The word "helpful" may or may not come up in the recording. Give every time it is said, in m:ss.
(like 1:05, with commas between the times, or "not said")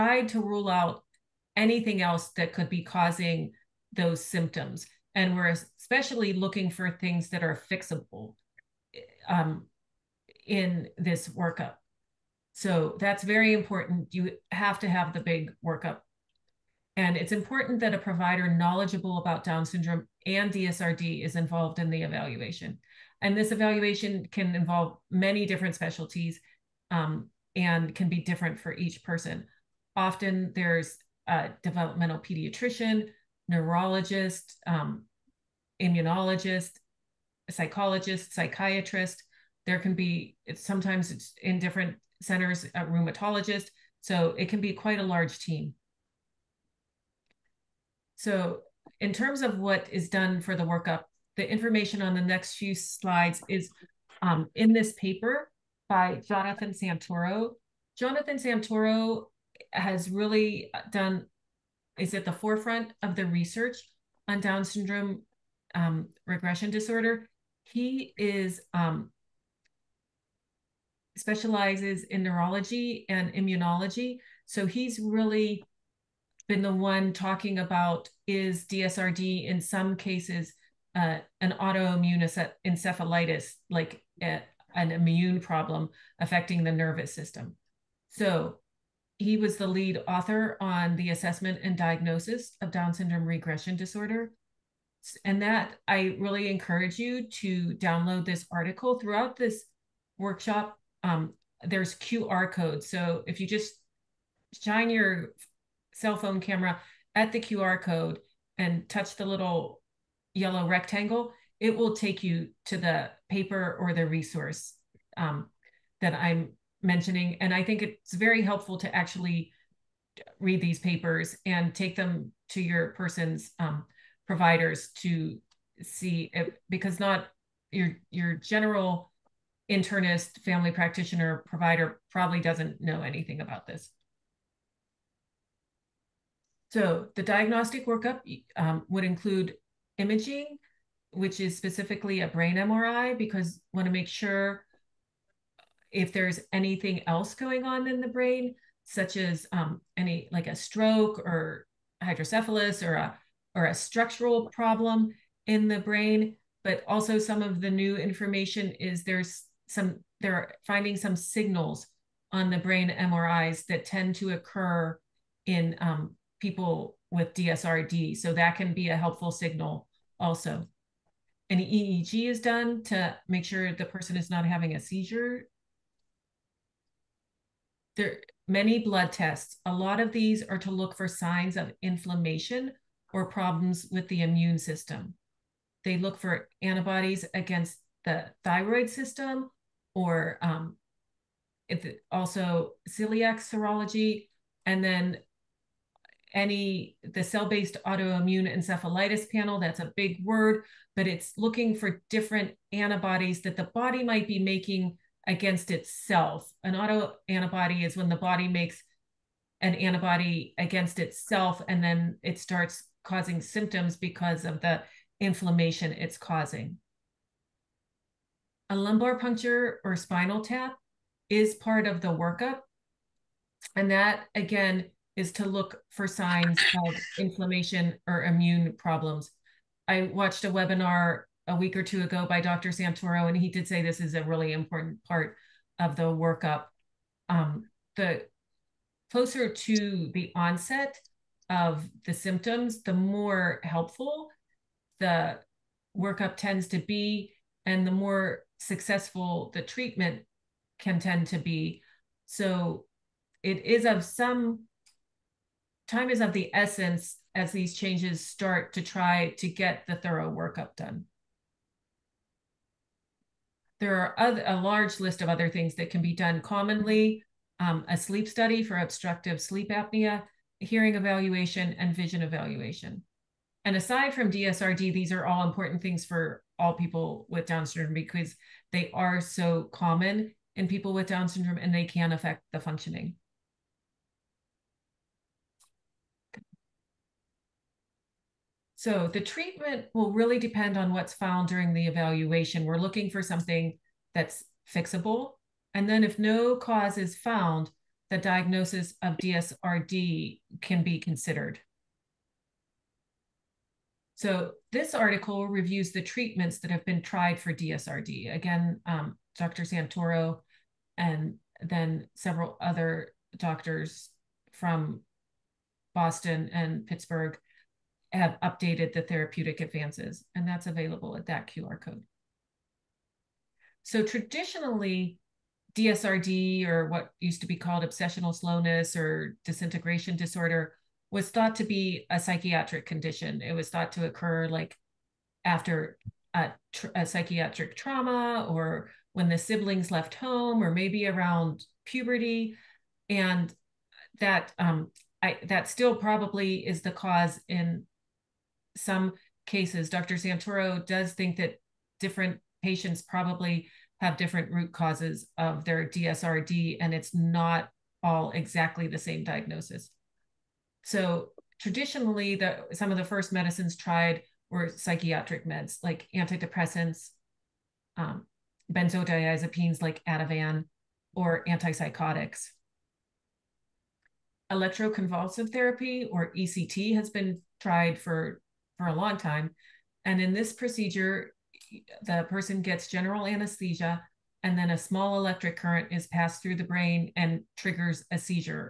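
1:58, 2:48, 4:03.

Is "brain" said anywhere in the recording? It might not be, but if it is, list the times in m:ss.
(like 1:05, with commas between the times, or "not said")
2:22, 2:28, 2:35, 2:42, 6:26.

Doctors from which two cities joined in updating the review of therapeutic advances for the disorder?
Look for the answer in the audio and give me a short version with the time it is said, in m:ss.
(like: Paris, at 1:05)
Boston and Pittsburgh, at 5:15.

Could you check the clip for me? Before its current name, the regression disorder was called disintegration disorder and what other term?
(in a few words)
obsessional slowness.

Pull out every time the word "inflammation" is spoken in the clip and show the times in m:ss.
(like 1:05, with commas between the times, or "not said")
3:01, 3:35, 3:47.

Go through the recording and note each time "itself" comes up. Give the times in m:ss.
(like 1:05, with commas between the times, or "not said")
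3:25, 3:30.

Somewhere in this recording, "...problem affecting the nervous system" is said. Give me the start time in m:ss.
1:25.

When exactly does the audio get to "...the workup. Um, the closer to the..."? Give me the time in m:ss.
3:55.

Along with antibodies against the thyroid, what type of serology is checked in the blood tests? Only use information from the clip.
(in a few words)
celiac serology.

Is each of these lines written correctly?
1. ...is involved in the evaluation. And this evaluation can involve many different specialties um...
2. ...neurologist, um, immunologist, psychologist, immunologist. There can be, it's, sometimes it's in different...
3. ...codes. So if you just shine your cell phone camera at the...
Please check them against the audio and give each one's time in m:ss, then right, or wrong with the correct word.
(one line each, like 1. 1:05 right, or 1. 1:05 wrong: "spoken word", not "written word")
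1. 0:21 right
2. 0:33 wrong: "psychiatrist", not "immunologist"
3. 1:42 right.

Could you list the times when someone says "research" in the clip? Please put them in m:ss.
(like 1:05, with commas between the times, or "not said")
1:03.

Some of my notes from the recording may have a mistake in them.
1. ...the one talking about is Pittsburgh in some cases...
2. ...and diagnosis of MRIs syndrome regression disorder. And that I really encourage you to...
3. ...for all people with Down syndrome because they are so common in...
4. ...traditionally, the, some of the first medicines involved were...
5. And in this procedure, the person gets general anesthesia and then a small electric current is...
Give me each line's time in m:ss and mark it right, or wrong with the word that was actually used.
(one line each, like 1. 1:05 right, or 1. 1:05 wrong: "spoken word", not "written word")
1. 1:16 wrong: "DSRD", not "Pittsburgh"
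2. 1:31 wrong: "Down", not "MRIs"
3. 4:36 right
4. 6:01 wrong: "tried", not "involved"
5. 6:20 right.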